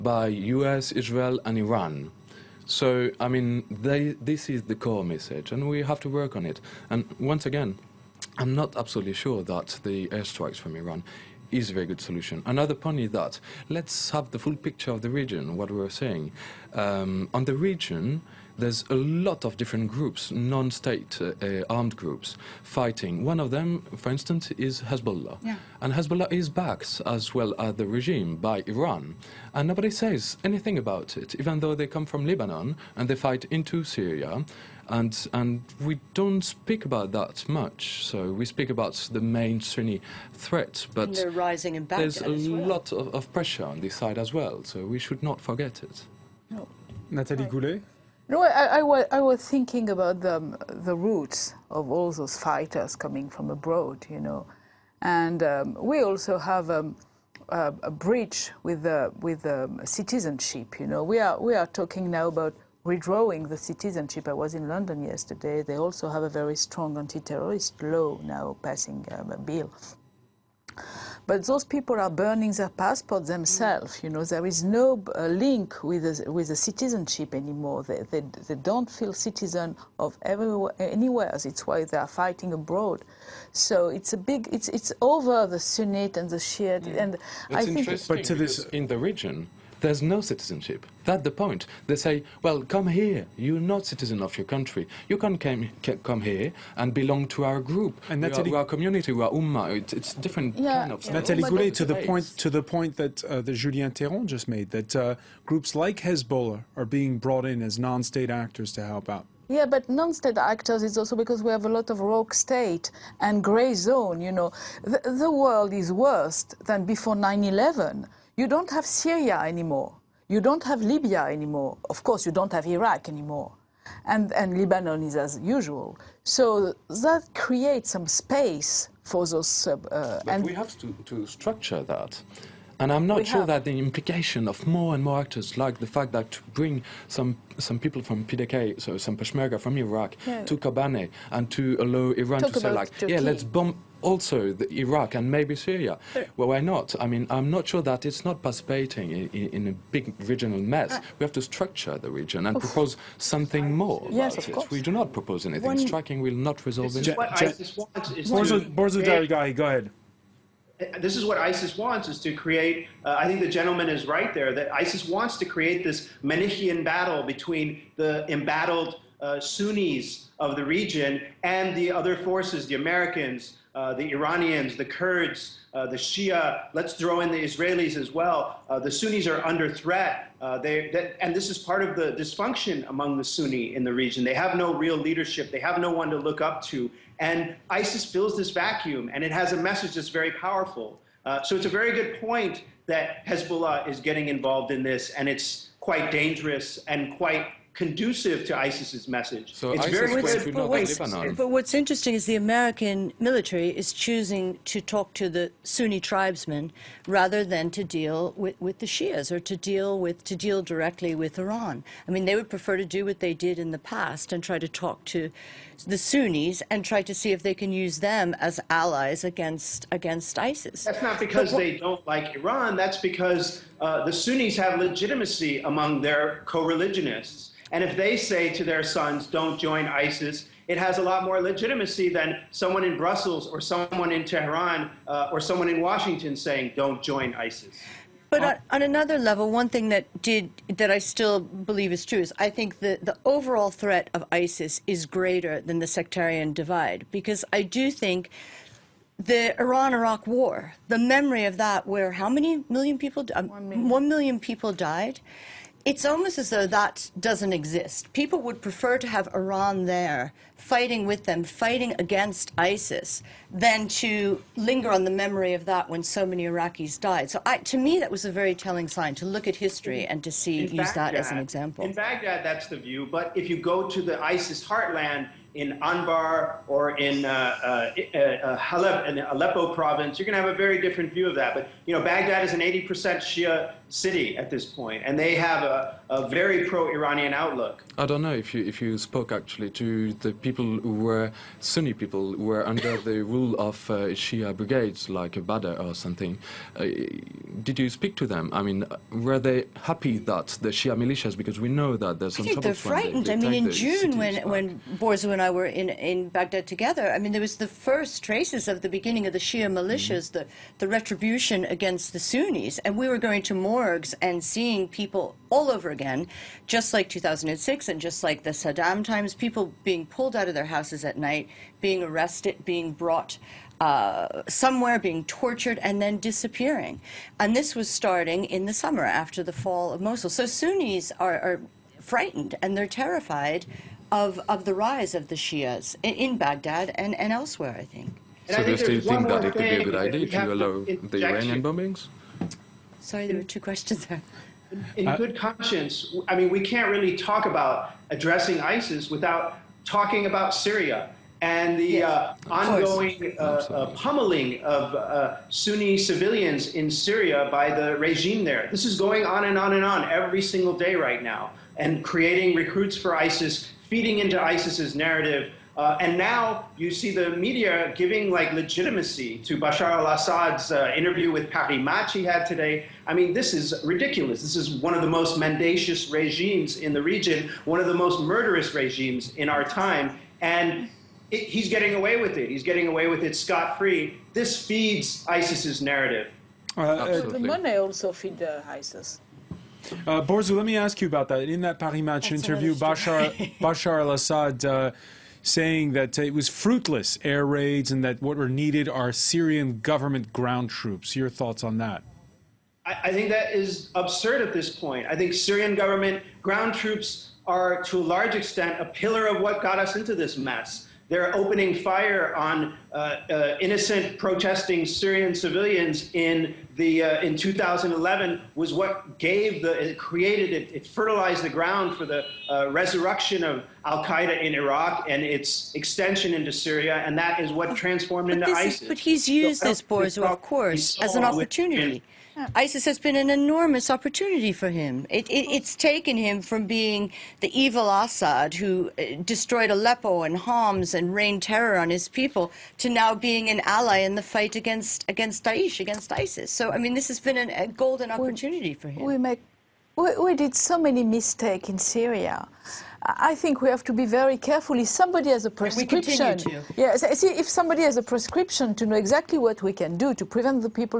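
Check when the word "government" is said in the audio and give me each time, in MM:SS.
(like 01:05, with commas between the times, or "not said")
06:39, 06:45.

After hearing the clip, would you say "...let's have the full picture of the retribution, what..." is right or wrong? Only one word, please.
wrong.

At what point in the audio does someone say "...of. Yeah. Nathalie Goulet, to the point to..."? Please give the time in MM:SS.
01:40.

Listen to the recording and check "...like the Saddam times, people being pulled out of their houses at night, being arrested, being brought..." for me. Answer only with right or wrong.
right.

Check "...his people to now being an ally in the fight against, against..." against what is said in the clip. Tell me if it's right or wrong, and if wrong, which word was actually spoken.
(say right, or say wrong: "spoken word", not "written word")
right.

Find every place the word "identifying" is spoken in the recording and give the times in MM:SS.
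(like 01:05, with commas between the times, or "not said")
not said.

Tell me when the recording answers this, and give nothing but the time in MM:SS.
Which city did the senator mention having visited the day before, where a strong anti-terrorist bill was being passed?
01:04.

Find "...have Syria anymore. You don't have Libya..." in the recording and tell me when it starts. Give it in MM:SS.
01:58.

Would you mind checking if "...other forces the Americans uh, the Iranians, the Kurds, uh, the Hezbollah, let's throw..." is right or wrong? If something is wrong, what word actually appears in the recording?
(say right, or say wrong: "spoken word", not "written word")
wrong: "Shia", not "Hezbollah".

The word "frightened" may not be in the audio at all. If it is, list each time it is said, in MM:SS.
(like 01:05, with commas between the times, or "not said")
05:02, 05:32.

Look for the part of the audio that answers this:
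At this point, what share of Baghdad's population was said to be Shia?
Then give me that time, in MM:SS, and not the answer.
04:42.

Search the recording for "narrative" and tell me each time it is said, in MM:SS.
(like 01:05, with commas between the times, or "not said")
06:04, 06:25.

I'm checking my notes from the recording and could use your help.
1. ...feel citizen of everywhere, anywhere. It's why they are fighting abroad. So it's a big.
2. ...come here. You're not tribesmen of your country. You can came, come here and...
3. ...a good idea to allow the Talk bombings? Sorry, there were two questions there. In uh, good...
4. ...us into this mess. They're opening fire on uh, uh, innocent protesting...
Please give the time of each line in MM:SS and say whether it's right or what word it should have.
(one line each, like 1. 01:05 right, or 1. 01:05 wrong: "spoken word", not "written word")
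1. 01:18 right
2. 01:32 wrong: "citizen", not "tribesmen"
3. 05:39 wrong: "Iranian", not "Talk"
4. 06:49 right.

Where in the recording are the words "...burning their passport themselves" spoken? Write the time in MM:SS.
01:12.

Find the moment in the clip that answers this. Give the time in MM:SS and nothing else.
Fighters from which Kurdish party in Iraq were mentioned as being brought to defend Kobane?
02:18.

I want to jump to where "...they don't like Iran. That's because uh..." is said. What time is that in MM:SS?
03:41.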